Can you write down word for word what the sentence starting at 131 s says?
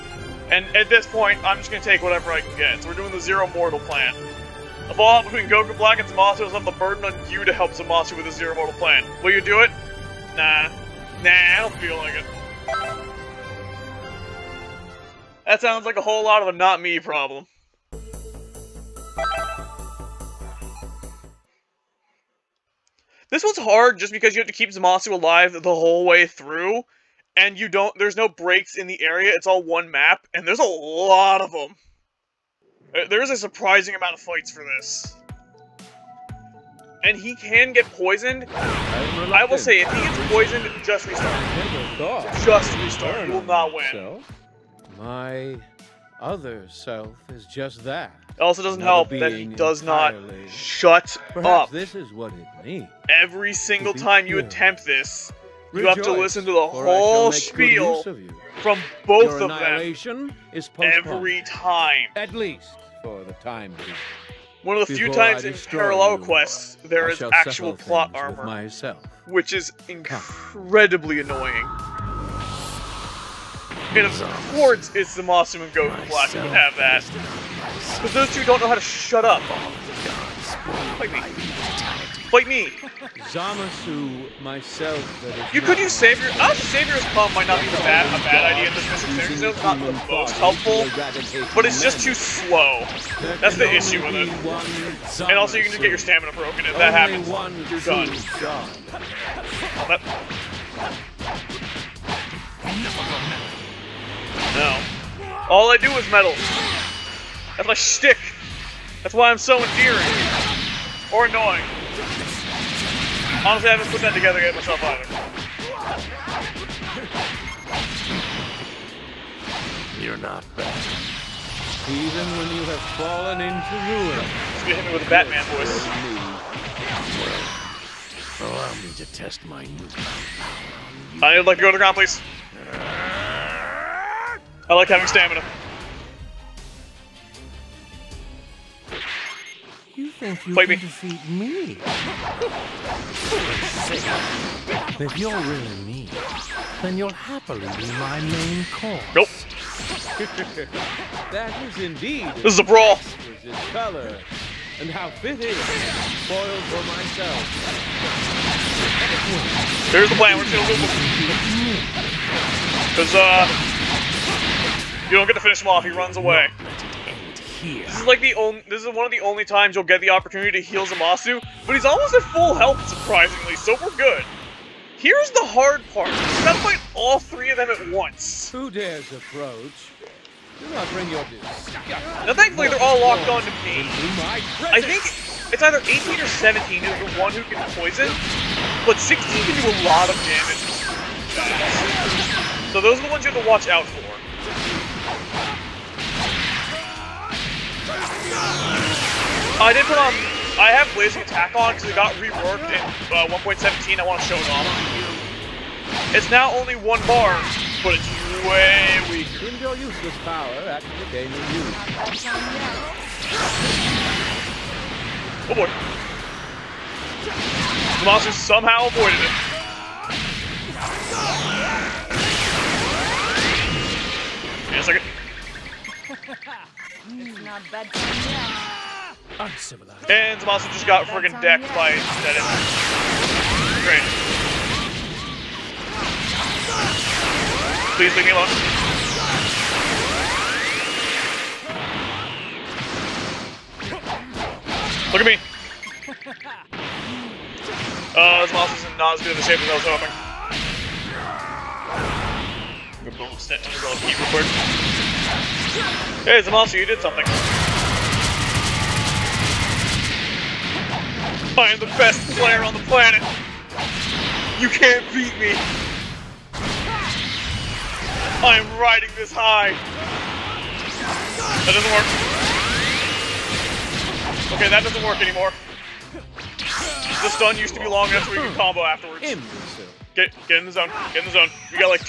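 I need to let go to the ground, please.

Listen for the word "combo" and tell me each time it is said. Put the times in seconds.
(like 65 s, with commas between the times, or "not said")
278 s.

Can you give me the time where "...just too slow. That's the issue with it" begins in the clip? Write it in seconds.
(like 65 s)
91 s.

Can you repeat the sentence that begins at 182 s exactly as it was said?
Now thankfully they're all locked on to me.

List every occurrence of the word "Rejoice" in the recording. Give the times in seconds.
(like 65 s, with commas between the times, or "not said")
55 s.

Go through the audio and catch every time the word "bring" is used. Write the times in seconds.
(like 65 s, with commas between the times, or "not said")
180 s.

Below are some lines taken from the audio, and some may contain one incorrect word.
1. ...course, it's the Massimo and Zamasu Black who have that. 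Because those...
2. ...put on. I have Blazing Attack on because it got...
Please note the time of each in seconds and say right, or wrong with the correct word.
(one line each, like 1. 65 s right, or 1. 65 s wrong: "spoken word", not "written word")
1. 74 s wrong: "Goku", not "Zamasu"
2. 199 s right.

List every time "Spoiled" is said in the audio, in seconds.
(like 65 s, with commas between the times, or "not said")
156 s.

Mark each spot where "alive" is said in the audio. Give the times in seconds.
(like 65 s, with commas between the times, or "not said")
25 s.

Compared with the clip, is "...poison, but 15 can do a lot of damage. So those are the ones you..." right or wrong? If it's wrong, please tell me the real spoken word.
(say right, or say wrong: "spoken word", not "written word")
wrong: "16", not "15".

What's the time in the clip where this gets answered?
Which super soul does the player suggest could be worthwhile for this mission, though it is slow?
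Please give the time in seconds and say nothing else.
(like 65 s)
86 s.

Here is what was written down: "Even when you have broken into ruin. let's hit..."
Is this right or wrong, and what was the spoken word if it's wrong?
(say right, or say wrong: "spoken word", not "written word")
wrong: "fallen", not "broken".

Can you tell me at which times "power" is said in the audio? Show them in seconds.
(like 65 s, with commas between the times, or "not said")
129 s, 210 s.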